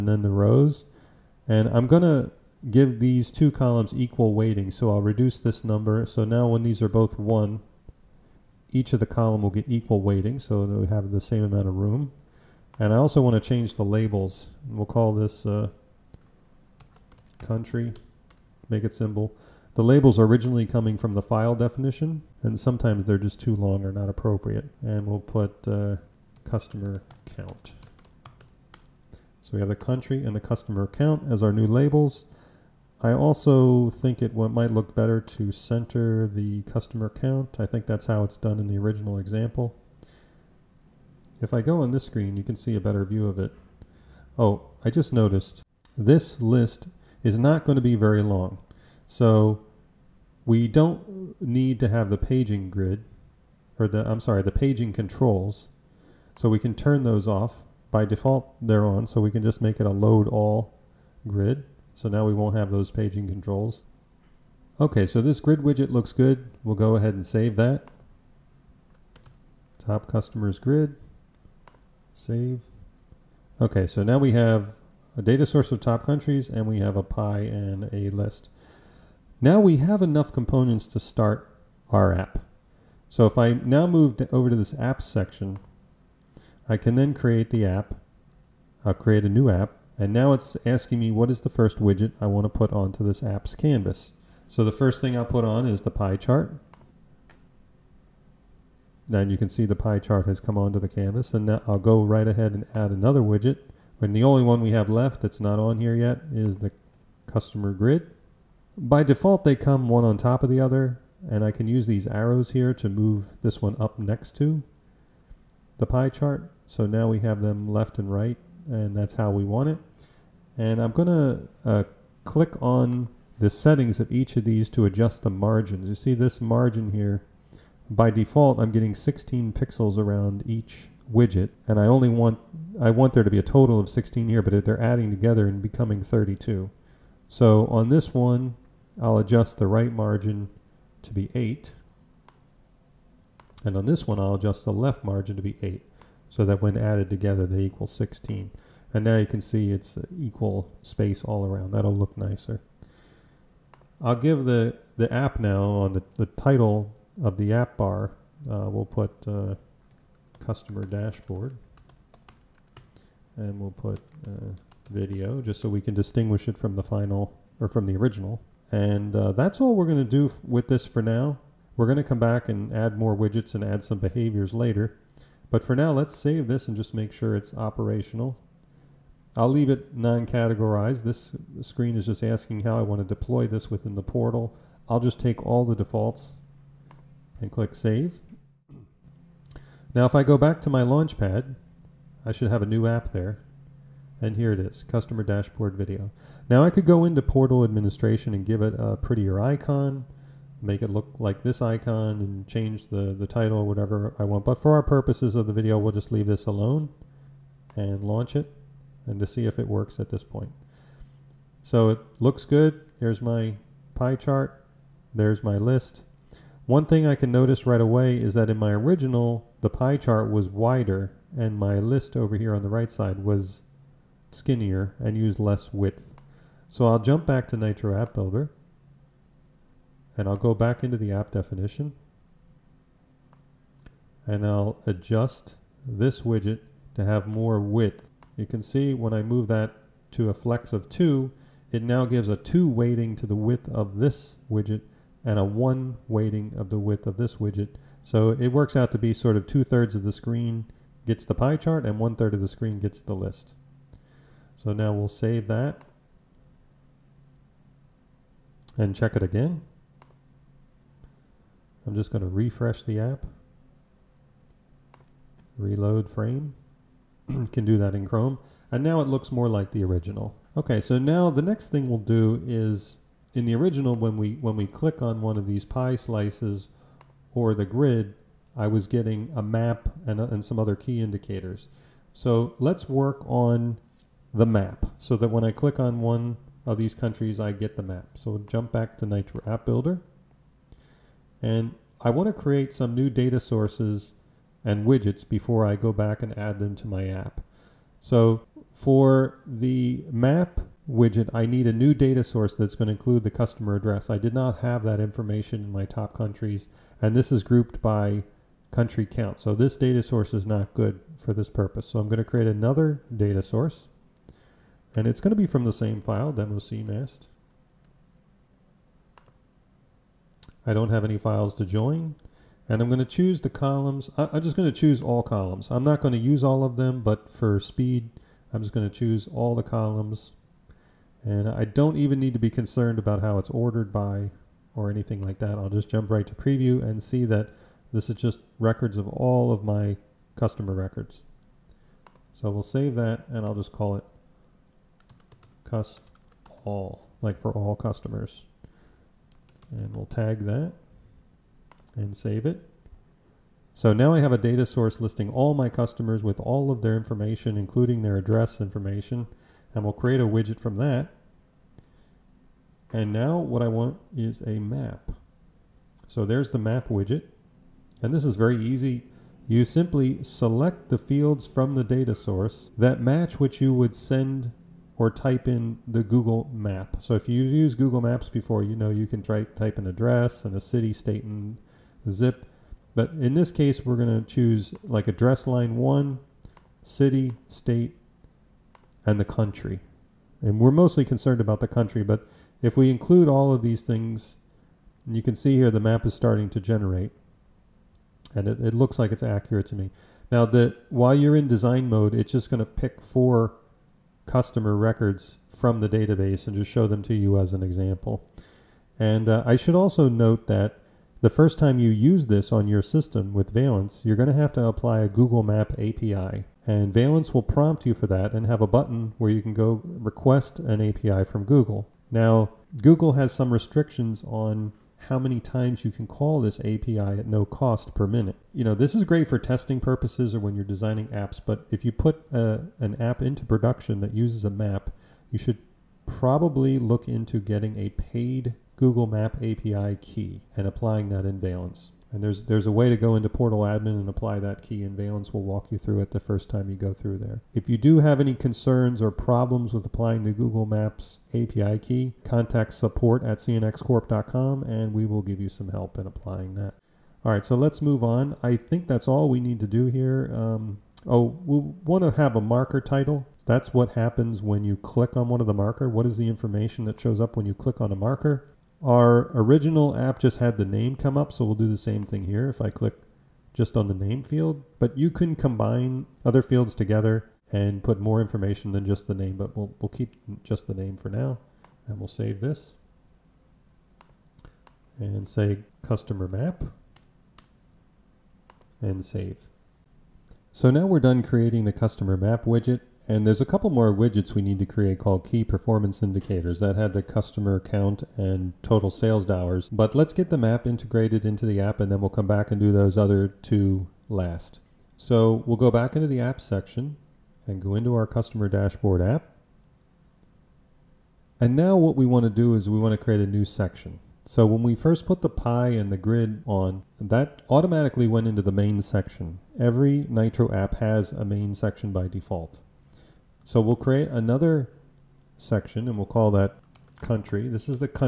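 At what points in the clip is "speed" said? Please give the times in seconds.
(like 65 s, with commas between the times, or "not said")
327 s.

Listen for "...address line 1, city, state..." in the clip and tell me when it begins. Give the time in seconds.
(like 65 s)
385 s.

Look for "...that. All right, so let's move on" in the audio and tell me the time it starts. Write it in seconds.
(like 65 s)
456 s.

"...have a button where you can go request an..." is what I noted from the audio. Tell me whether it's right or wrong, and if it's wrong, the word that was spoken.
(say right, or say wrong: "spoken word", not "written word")
right.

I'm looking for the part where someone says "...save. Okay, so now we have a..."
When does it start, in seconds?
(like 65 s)
72 s.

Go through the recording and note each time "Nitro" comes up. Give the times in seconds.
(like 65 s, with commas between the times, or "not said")
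227 s, 289 s, 520 s.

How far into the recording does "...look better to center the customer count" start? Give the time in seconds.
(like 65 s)
34 s.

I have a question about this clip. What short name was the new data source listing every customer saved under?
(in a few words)
cust all.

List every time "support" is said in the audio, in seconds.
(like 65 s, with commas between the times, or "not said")
452 s.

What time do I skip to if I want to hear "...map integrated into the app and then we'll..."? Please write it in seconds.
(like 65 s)
500 s.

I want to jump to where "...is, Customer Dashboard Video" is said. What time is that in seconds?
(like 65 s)
194 s.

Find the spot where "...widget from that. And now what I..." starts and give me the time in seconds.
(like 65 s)
360 s.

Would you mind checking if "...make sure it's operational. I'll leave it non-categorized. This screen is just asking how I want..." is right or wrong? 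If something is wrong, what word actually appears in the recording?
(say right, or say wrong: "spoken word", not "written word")
right.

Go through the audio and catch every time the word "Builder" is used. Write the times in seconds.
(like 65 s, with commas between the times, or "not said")
228 s, 289 s.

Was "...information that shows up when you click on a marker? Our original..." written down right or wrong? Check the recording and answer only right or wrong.
right.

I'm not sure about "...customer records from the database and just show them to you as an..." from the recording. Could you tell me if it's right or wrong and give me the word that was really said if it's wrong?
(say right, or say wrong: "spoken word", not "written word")
right.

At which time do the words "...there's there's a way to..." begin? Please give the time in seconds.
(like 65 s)
442 s.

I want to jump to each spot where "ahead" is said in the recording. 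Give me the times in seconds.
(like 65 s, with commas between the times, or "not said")
66 s, 102 s.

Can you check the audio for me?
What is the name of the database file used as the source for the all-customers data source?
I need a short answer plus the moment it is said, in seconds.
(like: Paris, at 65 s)
demo cmast, at 316 s.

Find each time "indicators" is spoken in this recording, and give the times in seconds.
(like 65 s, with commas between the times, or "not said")
280 s, 496 s.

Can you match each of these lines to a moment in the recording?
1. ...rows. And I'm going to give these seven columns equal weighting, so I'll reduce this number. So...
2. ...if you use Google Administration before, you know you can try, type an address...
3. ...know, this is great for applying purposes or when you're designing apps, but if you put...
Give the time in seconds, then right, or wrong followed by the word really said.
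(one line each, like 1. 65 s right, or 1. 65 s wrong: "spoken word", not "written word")
1. 0 s wrong: "two", not "seven"
2. 377 s wrong: "Maps", not "Administration"
3. 428 s wrong: "testing", not "applying".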